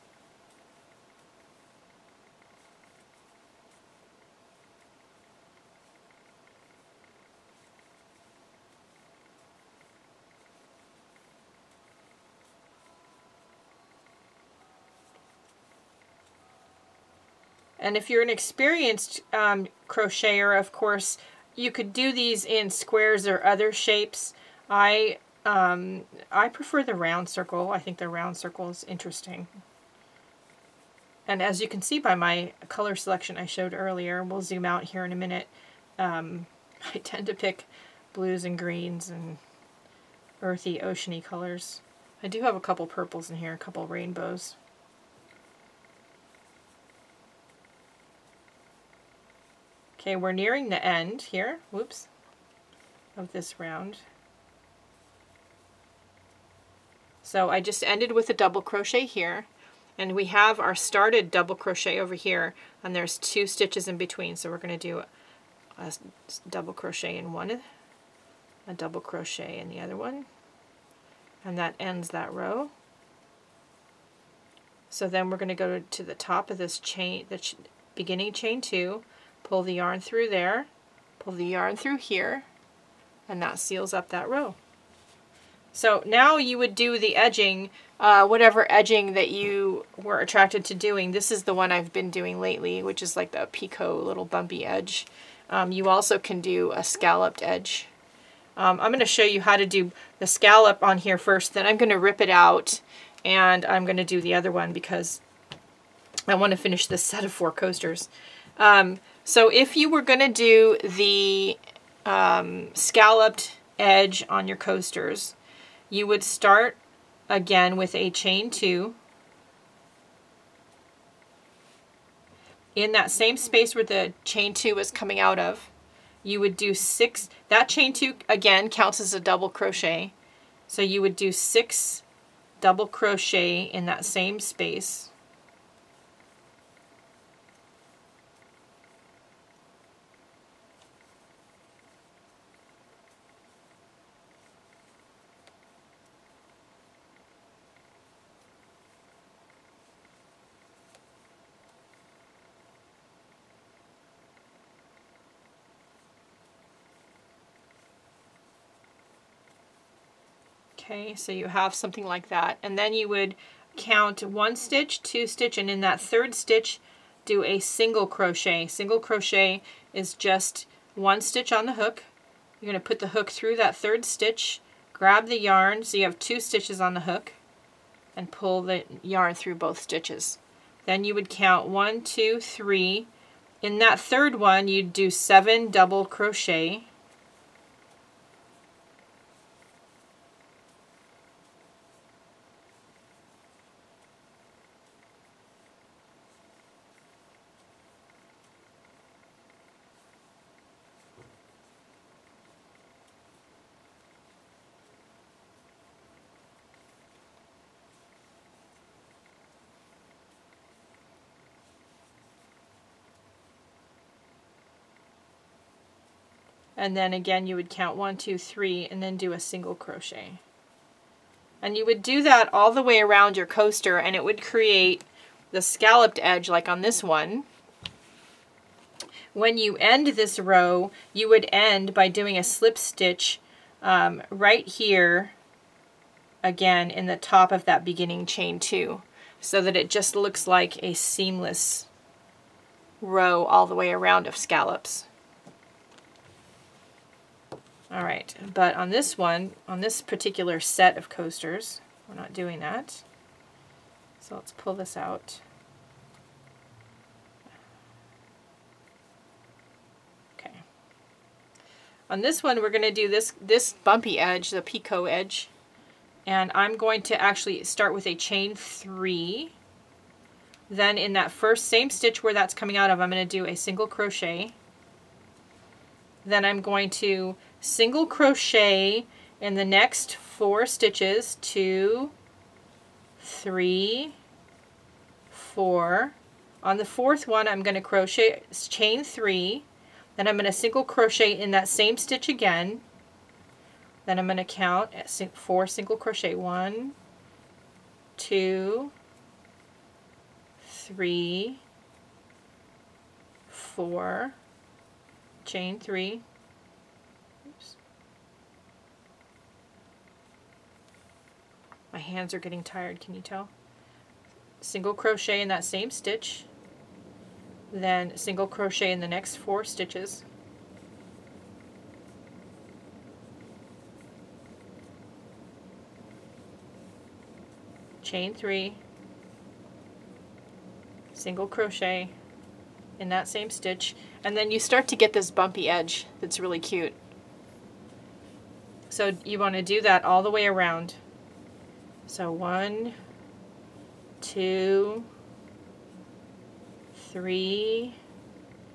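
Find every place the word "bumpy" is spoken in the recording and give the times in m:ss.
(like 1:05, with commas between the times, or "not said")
1:34, 4:23, 5:35.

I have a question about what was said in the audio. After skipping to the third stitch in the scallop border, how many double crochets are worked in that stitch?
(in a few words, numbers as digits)
7.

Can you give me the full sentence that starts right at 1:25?
So now you would do the edging, uh, whatever edging that you were attracted to doing.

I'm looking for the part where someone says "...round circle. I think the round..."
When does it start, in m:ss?
0:26.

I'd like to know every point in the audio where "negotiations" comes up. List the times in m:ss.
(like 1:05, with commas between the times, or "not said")
not said.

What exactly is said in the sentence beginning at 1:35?
Um, you also can do a scalloped edge.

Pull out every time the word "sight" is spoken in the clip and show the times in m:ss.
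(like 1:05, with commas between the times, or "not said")
not said.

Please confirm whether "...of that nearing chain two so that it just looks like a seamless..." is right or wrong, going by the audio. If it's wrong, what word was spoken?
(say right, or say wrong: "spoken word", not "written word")
wrong: "beginning", not "nearing".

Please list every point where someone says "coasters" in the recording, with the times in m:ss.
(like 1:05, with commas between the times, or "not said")
1:47, 1:54, 3:43, 4:11.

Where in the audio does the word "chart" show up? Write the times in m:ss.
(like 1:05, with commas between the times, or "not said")
not said.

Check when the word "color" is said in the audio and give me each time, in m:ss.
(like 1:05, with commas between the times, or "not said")
0:32, 0:41.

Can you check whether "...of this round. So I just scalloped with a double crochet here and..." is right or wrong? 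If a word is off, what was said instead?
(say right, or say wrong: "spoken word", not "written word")
wrong: "ended", not "scalloped".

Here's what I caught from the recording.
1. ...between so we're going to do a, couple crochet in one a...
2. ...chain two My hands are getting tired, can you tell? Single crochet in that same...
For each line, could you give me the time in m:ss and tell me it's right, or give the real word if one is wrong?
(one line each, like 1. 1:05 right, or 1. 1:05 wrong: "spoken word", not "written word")
1. 1:03 wrong: "double", not "couple"
2. 5:05 wrong: "three", not "two".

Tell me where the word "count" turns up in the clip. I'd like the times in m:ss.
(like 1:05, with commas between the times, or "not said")
2:08, 2:43, 3:01, 3:37, 4:54.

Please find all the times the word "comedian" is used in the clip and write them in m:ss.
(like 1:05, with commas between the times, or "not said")
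not said.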